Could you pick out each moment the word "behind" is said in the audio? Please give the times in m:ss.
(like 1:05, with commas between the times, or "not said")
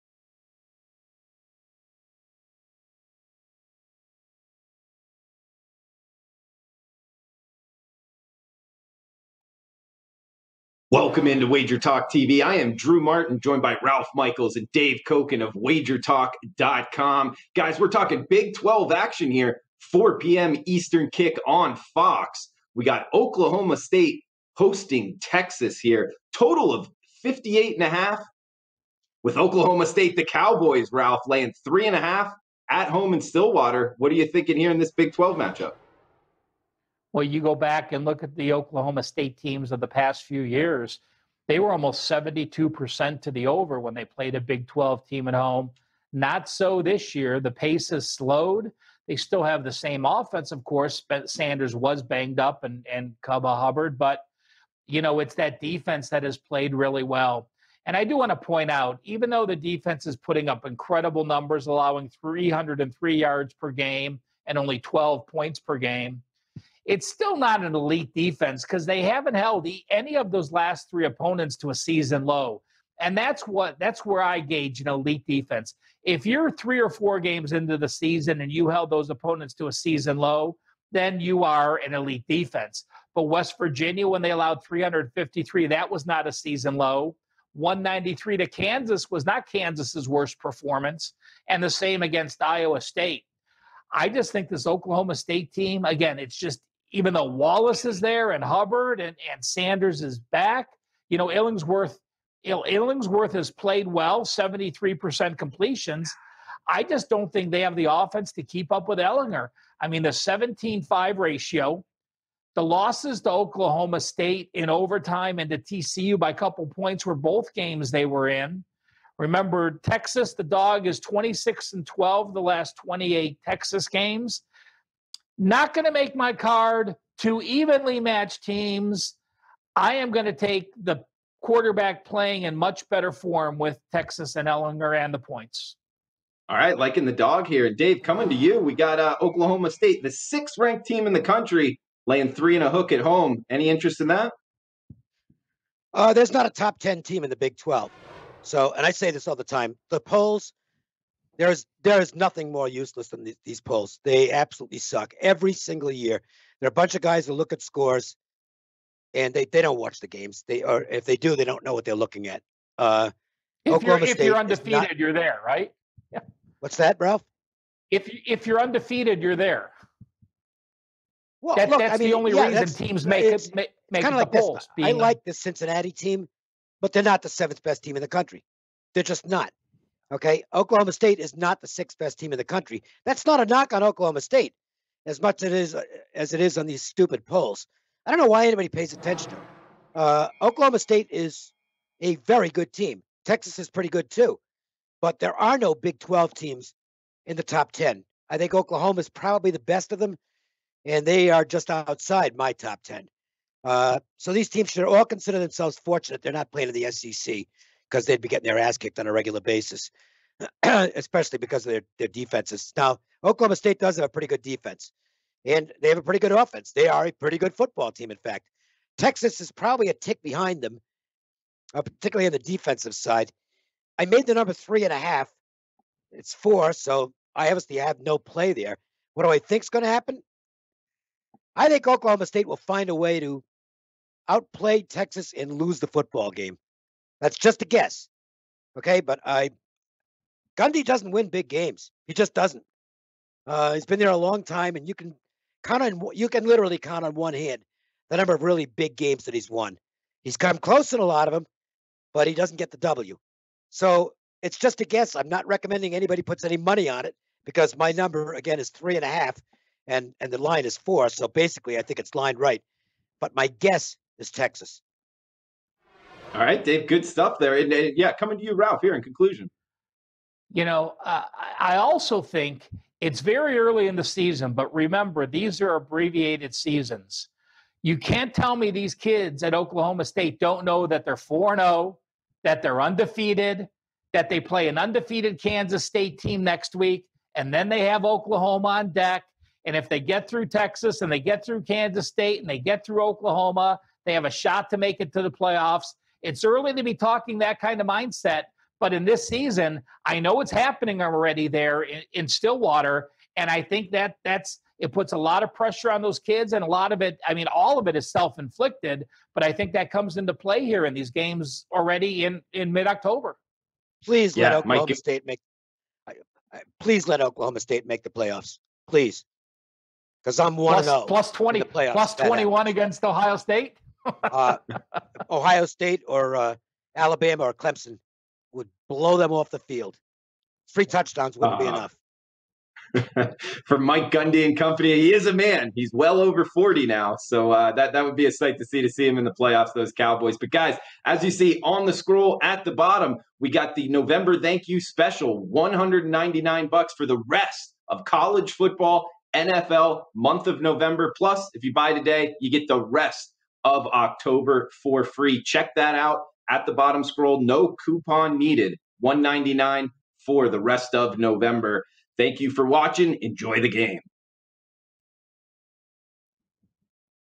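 3:40.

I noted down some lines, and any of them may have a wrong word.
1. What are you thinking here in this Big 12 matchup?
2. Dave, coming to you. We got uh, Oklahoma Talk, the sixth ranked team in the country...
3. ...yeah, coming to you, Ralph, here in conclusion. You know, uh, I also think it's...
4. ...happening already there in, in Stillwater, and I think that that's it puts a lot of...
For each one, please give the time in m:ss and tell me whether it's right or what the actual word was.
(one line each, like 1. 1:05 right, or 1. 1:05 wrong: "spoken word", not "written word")
1. 0:33 right
2. 2:17 wrong: "State", not "Talk"
3. 4:27 right
4. 5:00 right.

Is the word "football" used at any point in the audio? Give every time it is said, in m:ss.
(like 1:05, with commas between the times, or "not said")
3:37, 3:55, 5:48.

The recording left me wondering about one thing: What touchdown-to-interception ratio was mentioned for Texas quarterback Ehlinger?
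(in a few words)
17-5.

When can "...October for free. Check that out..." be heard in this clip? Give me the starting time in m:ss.
5:53.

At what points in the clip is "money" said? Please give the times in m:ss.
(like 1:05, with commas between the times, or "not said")
4:16.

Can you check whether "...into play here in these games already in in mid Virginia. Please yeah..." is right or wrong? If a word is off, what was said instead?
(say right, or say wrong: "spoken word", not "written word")
wrong: "October", not "Virginia".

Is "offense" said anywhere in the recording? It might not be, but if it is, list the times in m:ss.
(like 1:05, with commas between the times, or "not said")
0:50, 1:47, 3:36.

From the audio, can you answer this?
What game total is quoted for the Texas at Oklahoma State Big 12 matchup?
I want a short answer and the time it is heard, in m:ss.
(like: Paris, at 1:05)
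58.5, at 0:27.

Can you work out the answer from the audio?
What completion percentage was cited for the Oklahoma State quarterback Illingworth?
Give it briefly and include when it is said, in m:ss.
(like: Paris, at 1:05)
73%, at 1:44.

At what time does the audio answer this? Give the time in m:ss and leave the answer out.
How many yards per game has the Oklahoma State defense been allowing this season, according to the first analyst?
1:02.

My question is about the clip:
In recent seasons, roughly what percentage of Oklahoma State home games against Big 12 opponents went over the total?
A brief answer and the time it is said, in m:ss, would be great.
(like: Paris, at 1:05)
72%, at 0:42.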